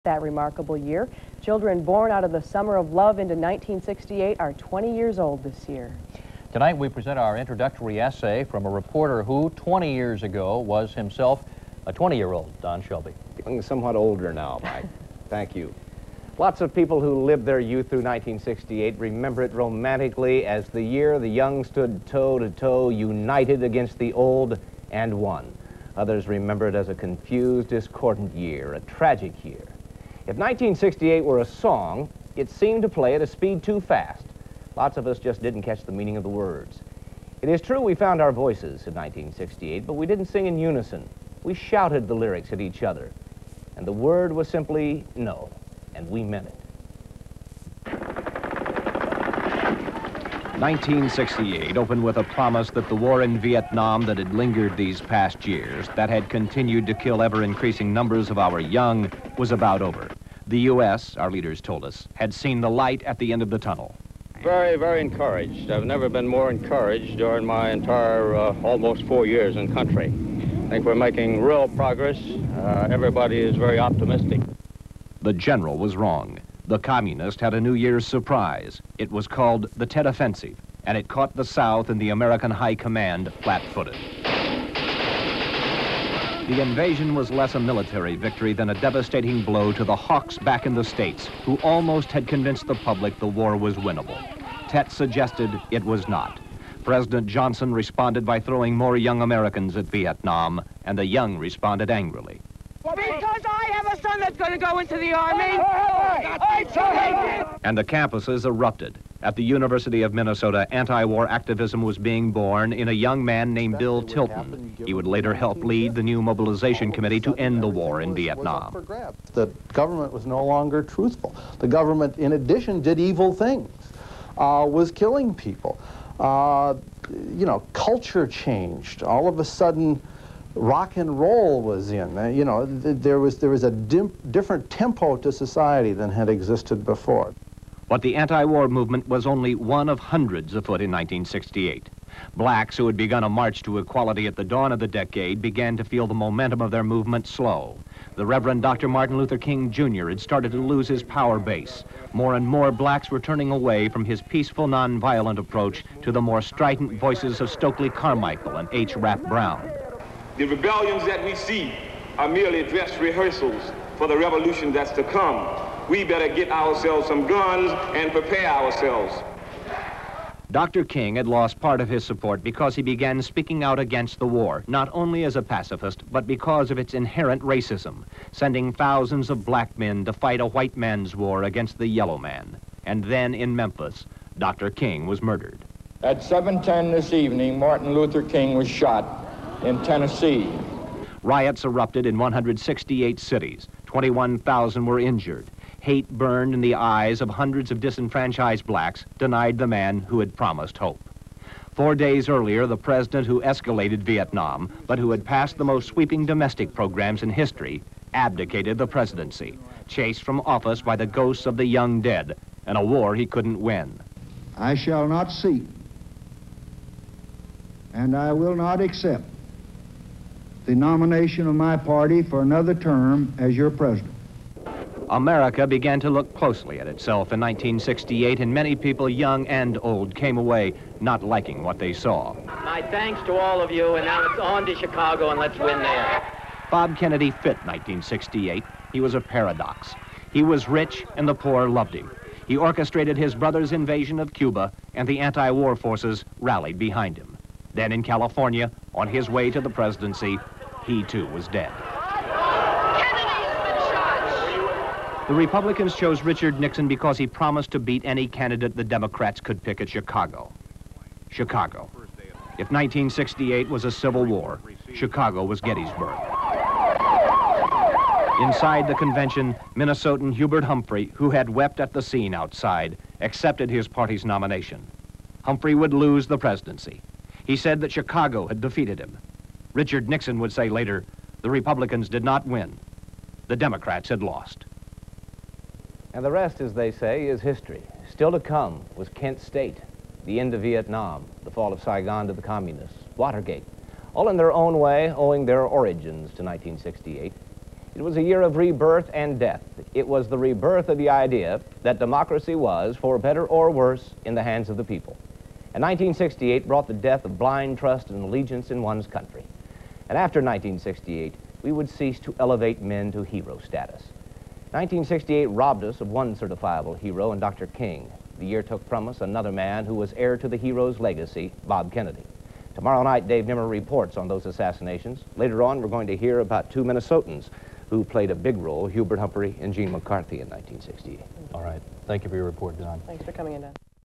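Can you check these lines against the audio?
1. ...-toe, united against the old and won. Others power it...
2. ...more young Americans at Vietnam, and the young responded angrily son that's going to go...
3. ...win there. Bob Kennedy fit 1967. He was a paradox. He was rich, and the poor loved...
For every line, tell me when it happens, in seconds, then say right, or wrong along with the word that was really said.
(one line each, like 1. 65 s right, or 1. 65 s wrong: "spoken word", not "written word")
1. 22 s wrong: "remember", not "power"
2. 98 s right
3. 235 s wrong: "1968", not "1967".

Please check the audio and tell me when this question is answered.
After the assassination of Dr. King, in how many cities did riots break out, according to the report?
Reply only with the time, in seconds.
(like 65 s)
192 s.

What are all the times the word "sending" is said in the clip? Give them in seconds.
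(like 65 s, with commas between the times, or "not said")
178 s.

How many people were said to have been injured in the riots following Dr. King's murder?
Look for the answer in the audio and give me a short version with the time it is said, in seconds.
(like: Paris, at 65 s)
21,000, at 193 s.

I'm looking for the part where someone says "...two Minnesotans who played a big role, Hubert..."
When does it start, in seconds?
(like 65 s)
326 s.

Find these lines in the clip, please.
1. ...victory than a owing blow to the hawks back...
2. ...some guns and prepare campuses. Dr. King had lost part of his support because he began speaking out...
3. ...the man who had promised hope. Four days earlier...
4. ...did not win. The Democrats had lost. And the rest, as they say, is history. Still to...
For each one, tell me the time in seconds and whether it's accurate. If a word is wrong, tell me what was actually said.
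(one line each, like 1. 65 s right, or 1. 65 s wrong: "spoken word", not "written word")
1. 88 s wrong: "devastating", not "owing"
2. 167 s wrong: "ourselves", not "campuses"
3. 199 s right
4. 282 s right.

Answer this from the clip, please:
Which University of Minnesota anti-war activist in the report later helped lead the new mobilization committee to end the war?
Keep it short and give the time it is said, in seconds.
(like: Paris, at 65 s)
Bill Tilton, at 113 s.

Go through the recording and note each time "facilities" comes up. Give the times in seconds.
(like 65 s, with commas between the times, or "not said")
not said.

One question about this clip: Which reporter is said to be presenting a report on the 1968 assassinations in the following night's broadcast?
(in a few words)
Dave Nimmer.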